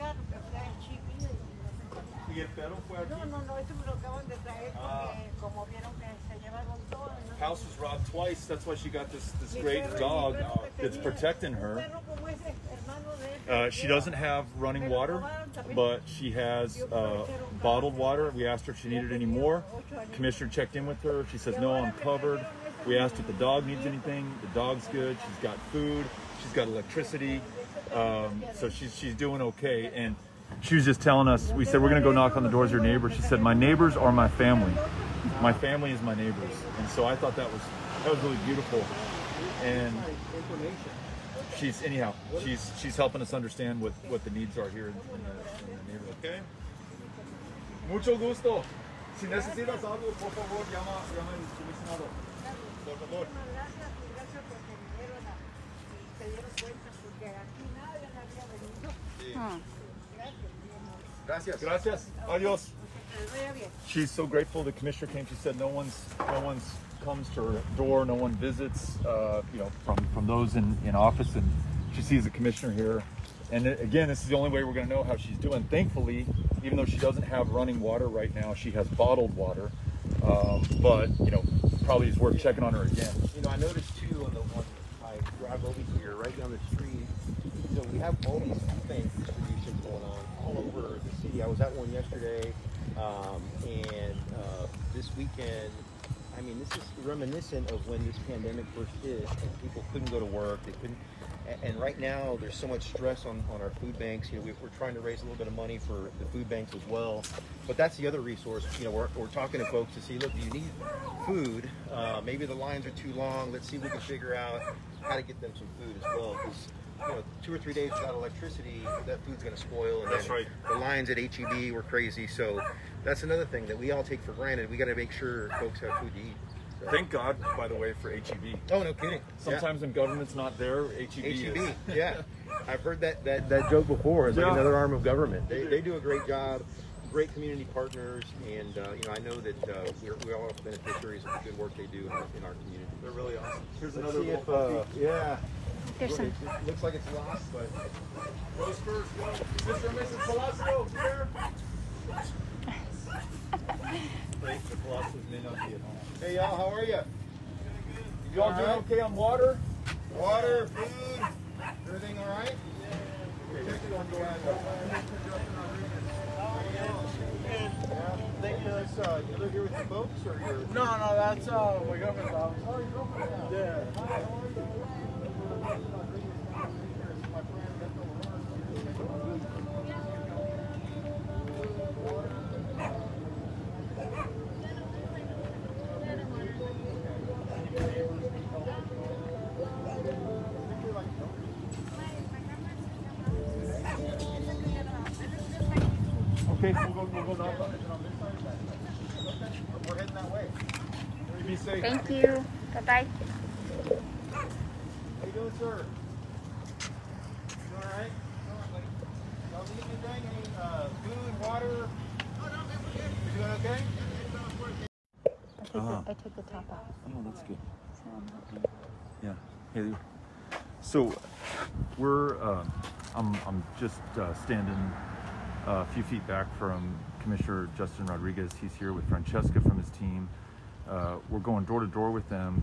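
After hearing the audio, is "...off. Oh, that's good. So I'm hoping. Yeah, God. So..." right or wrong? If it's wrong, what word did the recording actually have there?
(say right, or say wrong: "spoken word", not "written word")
wrong: "Haley", not "God".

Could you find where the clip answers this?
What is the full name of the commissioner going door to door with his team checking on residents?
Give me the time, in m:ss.
3:47.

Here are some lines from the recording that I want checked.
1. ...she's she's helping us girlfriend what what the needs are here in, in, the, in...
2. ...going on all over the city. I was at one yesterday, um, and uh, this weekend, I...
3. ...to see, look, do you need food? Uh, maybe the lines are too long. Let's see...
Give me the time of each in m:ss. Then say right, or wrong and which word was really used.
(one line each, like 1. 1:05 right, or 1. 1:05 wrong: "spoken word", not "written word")
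1. 0:42 wrong: "understand", not "girlfriend"
2. 1:29 right
3. 1:49 right.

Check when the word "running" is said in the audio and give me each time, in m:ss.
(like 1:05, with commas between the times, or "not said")
0:14, 1:17.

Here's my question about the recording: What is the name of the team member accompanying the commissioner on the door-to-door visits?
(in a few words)
Francesca.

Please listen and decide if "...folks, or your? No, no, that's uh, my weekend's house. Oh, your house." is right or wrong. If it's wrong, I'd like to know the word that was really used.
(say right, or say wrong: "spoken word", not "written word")
wrong: "girlfriend", not "weekend".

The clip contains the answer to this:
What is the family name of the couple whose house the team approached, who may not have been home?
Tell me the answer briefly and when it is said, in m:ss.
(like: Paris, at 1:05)
Velasco, at 2:30.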